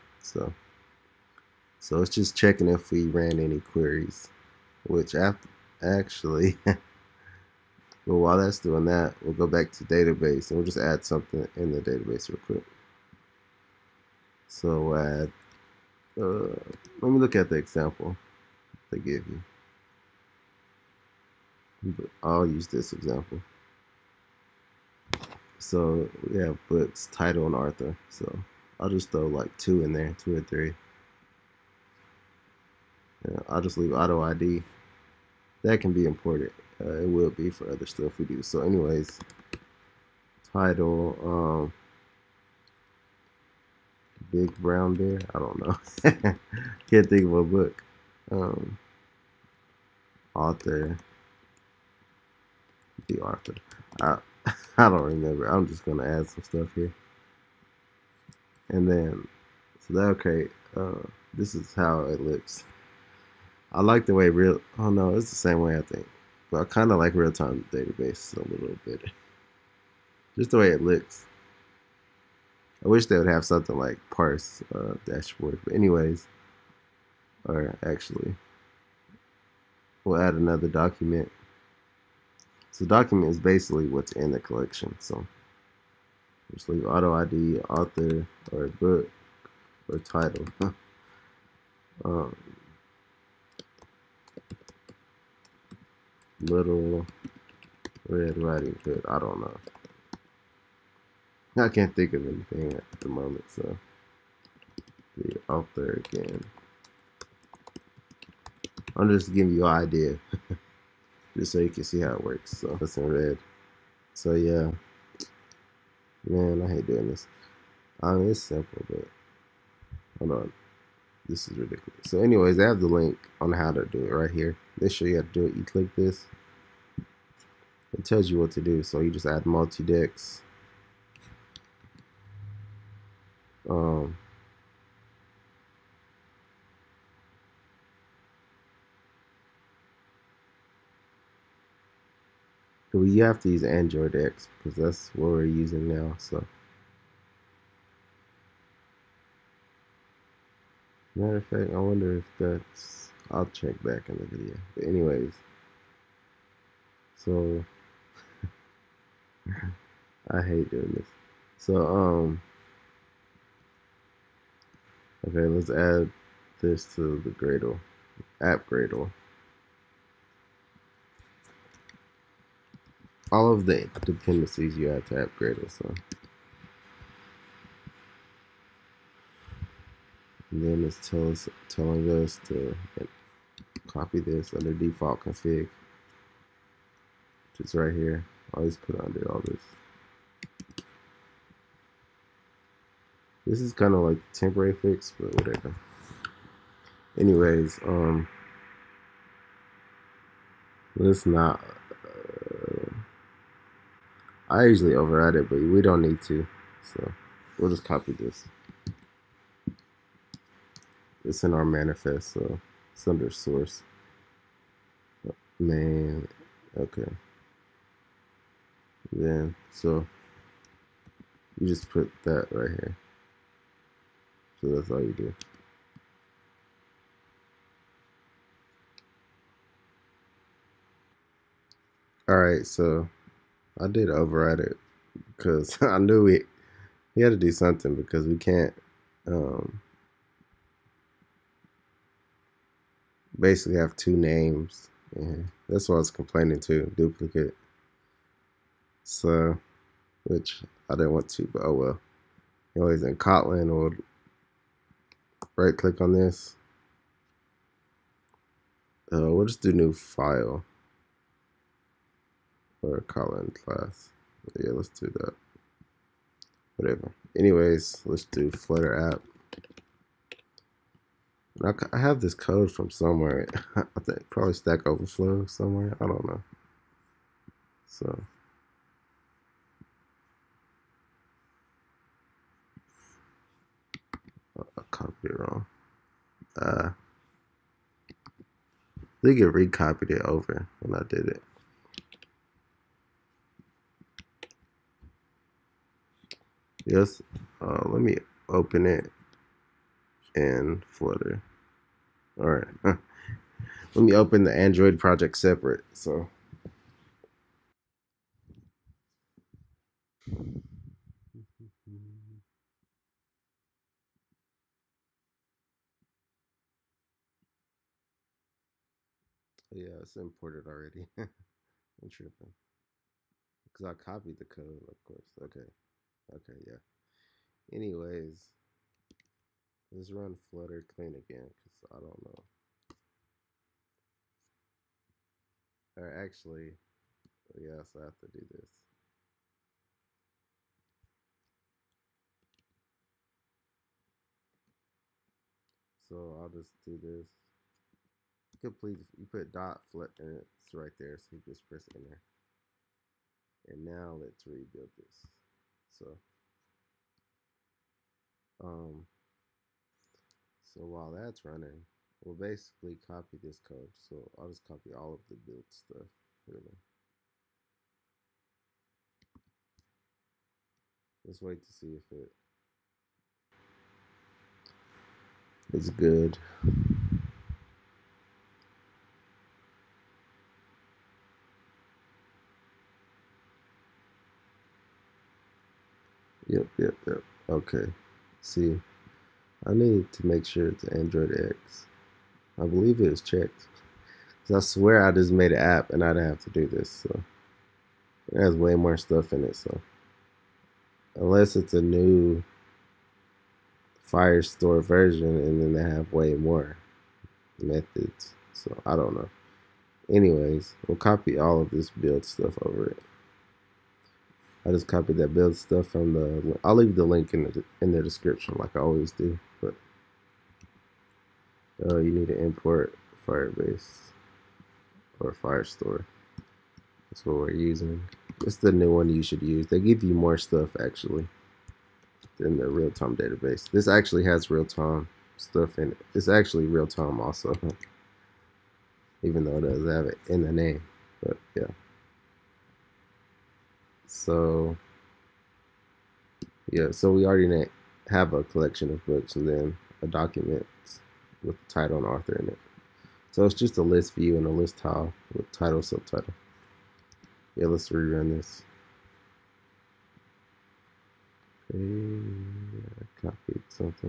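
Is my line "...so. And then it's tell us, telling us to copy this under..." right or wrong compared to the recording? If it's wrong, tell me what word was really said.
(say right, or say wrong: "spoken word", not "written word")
right.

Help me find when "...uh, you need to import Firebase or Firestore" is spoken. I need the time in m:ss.
7:01.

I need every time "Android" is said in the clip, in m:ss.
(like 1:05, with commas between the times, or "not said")
2:23, 5:04, 6:30.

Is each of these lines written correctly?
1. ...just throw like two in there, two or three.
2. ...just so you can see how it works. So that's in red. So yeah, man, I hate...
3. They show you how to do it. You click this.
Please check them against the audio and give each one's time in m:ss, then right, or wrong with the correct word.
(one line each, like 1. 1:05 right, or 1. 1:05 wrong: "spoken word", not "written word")
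1. 0:28 right
2. 1:51 right
3. 2:04 right.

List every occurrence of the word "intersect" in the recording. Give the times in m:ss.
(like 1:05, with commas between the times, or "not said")
not said.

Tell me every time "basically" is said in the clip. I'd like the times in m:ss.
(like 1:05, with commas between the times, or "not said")
1:23, 4:03, 6:02.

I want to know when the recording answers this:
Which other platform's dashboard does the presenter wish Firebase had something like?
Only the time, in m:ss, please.
1:14.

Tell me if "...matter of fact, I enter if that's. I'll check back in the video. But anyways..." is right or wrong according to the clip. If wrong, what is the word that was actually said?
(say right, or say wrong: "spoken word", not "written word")
wrong: "wonder", not "enter".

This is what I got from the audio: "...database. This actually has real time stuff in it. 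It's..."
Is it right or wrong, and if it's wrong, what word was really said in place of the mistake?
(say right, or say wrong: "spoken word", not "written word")
right.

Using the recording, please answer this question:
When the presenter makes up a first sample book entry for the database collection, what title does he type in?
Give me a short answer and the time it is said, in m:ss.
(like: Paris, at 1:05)
Big Brown Bear, at 0:44.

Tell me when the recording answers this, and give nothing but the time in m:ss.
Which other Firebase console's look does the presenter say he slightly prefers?
1:07.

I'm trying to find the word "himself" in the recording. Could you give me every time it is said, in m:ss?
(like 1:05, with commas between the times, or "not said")
not said.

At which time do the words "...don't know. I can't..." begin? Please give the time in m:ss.
1:39.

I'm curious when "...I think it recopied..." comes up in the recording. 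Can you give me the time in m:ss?
4:48.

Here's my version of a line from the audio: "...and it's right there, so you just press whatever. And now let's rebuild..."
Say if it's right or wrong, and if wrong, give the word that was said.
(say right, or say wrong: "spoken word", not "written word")
wrong: "enter", not "whatever".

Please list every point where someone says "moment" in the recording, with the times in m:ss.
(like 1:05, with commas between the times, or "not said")
1:43.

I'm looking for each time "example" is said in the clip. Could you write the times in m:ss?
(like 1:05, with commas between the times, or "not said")
0:17, 0:22.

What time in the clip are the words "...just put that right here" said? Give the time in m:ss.
3:41.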